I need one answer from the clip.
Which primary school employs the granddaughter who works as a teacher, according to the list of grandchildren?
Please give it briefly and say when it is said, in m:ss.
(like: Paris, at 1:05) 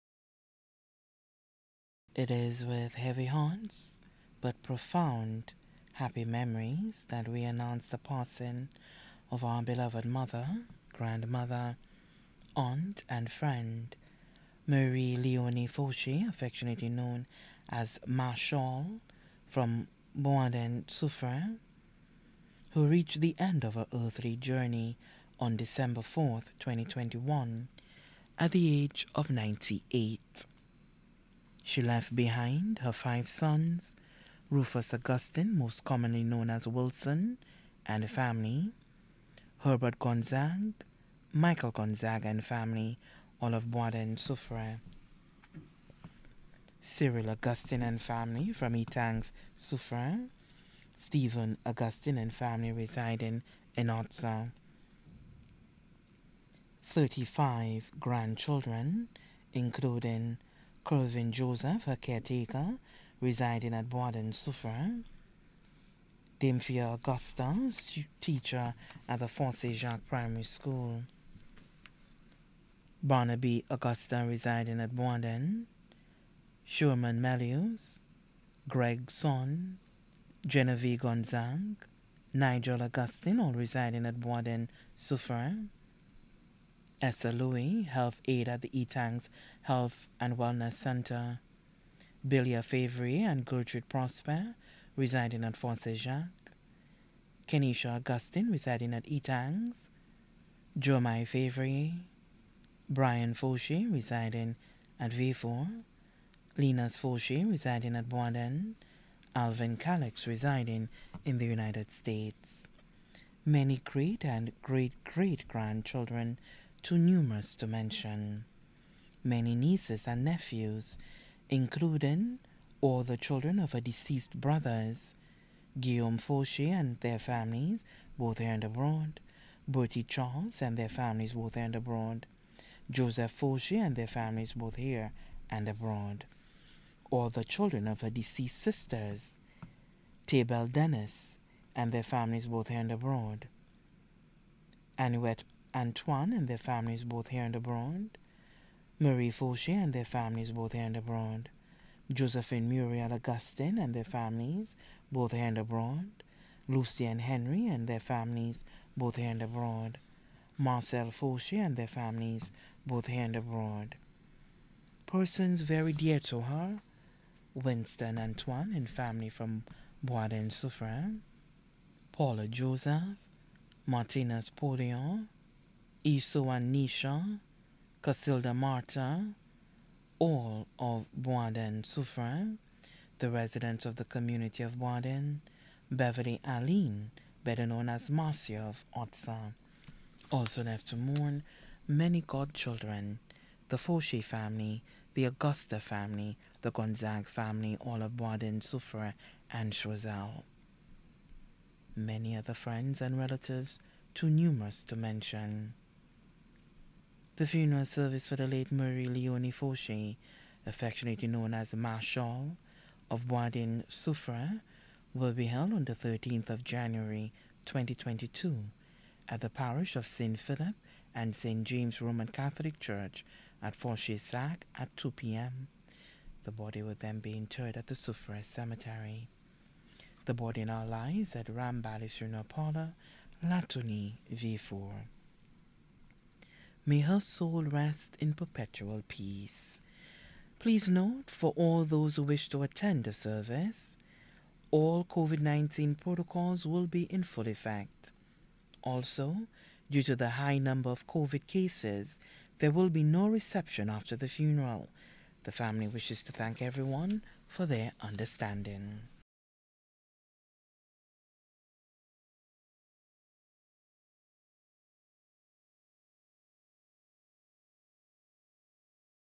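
Fossey Jacques Primary School, at 1:09.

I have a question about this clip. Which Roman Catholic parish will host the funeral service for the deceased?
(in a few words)
St. Philip and St. James.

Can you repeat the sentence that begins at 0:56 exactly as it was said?
35 grandchildren, including Colvin Joseph, a caretaker, residing at Boaden Suffren.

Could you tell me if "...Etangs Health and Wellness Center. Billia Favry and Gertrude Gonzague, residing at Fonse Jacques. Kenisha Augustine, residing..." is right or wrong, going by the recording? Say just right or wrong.
wrong.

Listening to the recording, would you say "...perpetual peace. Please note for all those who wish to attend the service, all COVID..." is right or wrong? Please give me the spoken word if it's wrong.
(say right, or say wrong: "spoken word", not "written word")
right.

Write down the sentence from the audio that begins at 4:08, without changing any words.
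Also, due to the high number of COVID cases, there will be no reception after the funeral.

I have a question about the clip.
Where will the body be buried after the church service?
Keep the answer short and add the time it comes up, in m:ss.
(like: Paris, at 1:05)
Souffre Cemetery, at 3:47.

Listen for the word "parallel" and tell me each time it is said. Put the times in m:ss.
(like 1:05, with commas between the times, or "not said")
not said.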